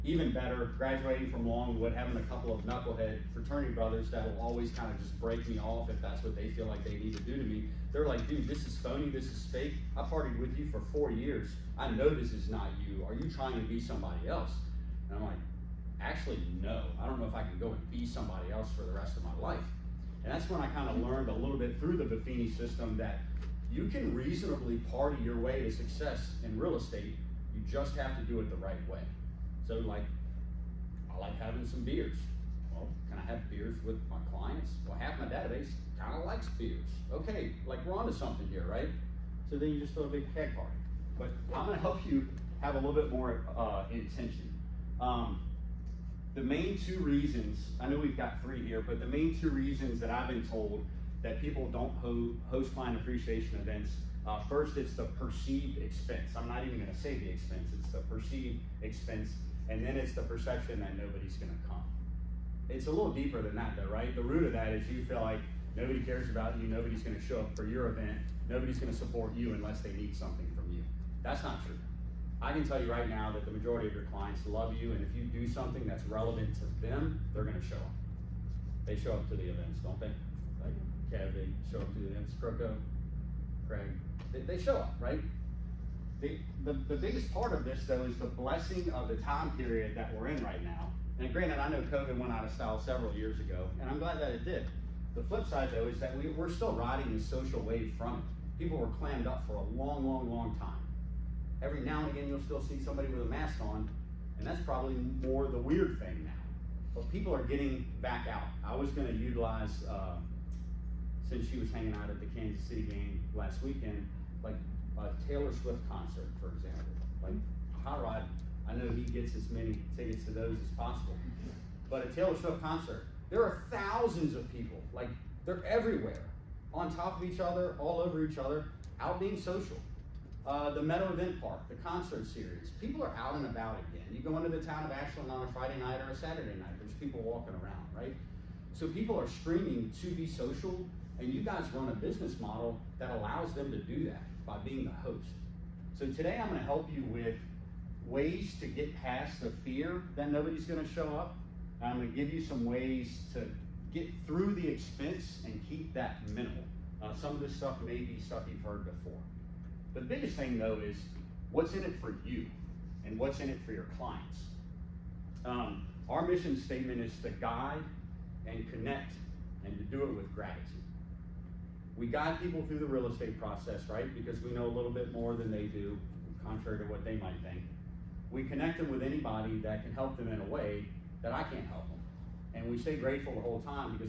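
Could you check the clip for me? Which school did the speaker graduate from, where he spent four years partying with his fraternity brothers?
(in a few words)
Longwood.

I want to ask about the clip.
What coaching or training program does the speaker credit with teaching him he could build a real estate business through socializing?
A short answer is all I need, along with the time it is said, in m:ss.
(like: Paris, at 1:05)
Buffini system, at 0:22.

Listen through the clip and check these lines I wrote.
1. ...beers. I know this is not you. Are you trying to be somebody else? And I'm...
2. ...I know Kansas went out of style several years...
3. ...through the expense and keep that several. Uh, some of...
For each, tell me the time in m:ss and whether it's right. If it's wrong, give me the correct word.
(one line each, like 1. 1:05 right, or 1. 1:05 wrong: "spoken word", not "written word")
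1. 0:11 wrong: "years", not "beers"
2. 1:31 wrong: "COVID", not "Kansas"
3. 2:34 wrong: "minimal", not "several".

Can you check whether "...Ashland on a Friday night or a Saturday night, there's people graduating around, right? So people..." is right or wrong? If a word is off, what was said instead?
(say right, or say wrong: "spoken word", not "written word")
wrong: "walking", not "graduating".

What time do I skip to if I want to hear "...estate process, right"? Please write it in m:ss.
2:53.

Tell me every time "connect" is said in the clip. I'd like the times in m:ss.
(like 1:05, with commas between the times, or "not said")
2:48, 2:58.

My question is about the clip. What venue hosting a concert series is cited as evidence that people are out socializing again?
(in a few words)
Meadow Event Park.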